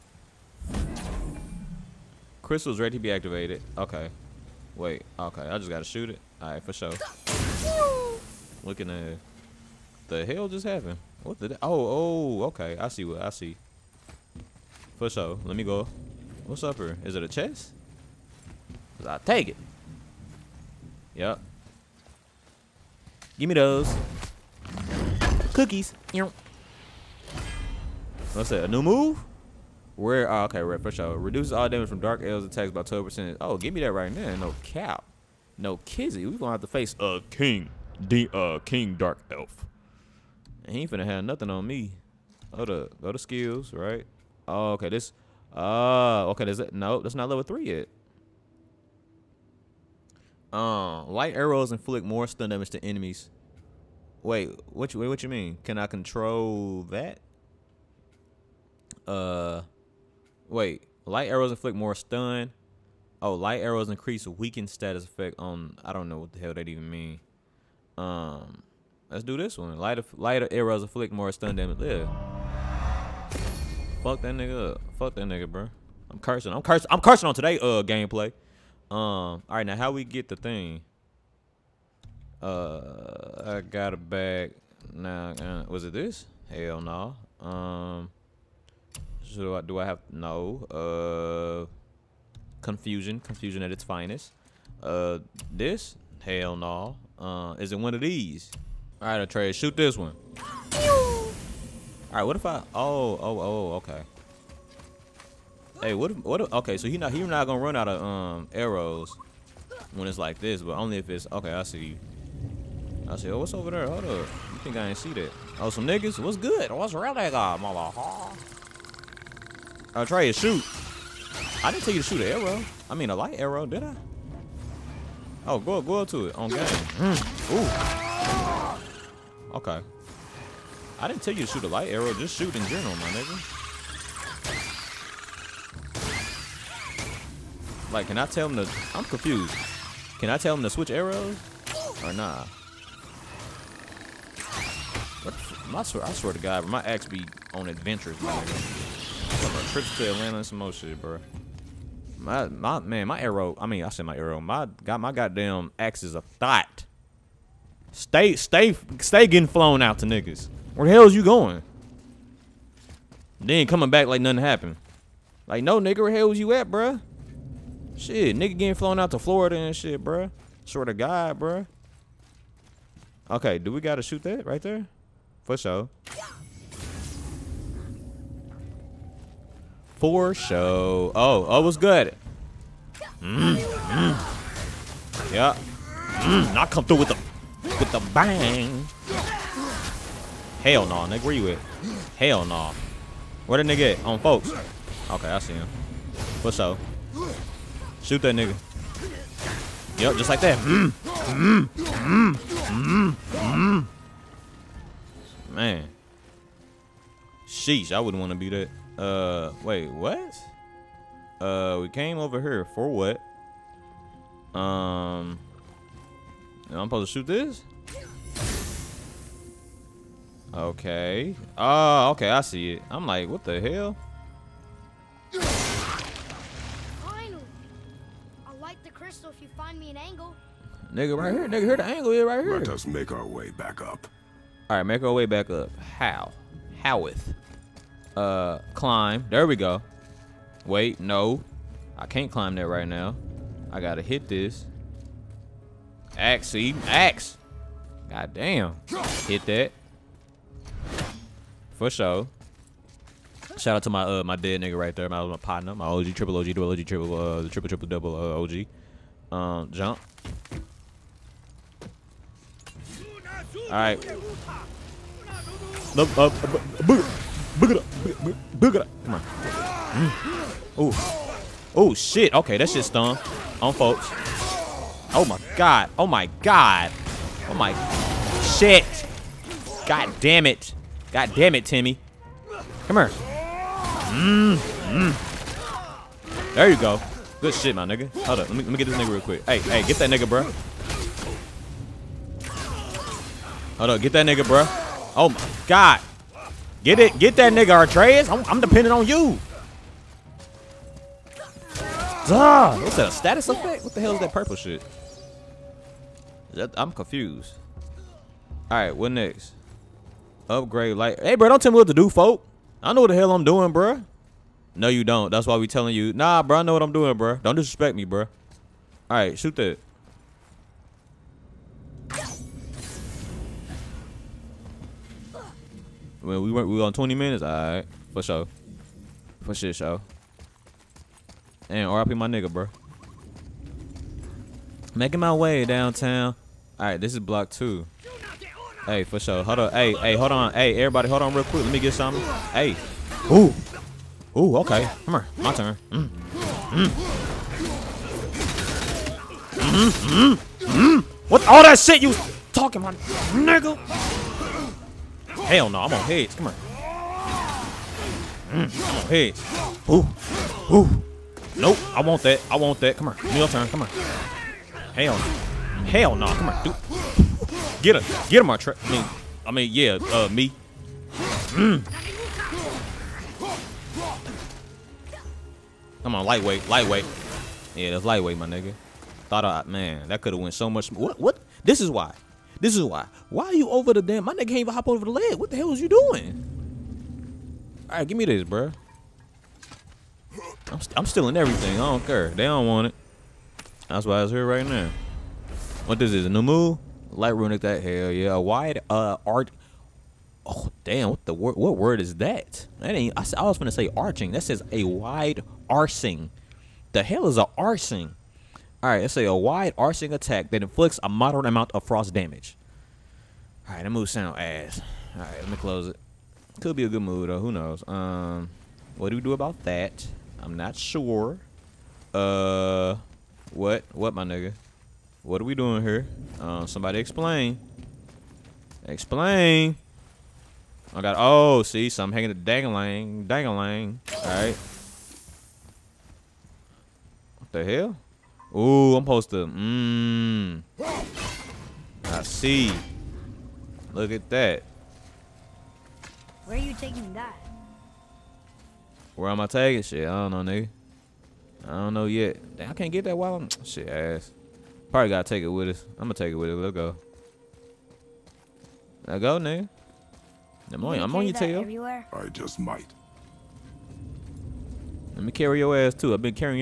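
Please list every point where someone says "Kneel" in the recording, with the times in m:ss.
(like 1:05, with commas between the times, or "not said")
6:03.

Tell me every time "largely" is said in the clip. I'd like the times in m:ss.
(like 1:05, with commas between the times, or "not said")
not said.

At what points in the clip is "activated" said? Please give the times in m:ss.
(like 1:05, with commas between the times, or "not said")
0:03.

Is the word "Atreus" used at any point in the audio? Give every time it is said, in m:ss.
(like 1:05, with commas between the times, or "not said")
1:39, 4:57.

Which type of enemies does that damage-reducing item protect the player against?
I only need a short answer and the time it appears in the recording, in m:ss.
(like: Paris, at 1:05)
Dark elves, at 0:31.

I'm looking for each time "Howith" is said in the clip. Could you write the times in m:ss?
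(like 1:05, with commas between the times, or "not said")
3:56.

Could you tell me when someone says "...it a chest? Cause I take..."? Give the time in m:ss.
0:17.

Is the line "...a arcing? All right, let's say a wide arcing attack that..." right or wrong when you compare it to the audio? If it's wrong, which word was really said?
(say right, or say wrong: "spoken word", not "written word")
right.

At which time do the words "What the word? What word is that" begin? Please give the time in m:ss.
6:41.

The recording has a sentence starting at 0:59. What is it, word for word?
Uh Wait, light arrows inflict more stun.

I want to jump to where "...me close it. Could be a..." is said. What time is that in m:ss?
6:55.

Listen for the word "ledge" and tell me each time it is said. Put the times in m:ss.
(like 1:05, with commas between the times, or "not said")
6:25.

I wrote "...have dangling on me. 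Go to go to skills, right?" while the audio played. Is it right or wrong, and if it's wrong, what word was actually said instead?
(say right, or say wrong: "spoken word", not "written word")
wrong: "nothing", not "dangling".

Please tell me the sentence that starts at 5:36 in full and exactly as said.
All right, this is block two.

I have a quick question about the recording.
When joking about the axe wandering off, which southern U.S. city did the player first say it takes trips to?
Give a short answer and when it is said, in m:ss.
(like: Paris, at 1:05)
Atlanta, at 2:30.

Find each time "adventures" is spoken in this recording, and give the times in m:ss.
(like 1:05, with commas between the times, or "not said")
2:27.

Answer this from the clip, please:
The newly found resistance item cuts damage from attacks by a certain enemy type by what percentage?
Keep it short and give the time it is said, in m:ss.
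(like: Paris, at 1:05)
12%, at 0:32.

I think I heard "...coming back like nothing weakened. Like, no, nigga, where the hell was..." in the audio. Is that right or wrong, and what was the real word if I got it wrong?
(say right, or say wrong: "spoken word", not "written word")
wrong: "happened", not "weakened".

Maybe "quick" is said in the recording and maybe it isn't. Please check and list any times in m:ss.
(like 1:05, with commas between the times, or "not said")
4:49, 5:41.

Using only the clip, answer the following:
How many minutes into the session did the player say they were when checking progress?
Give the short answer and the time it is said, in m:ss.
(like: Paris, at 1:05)
20 minutes, at 5:26.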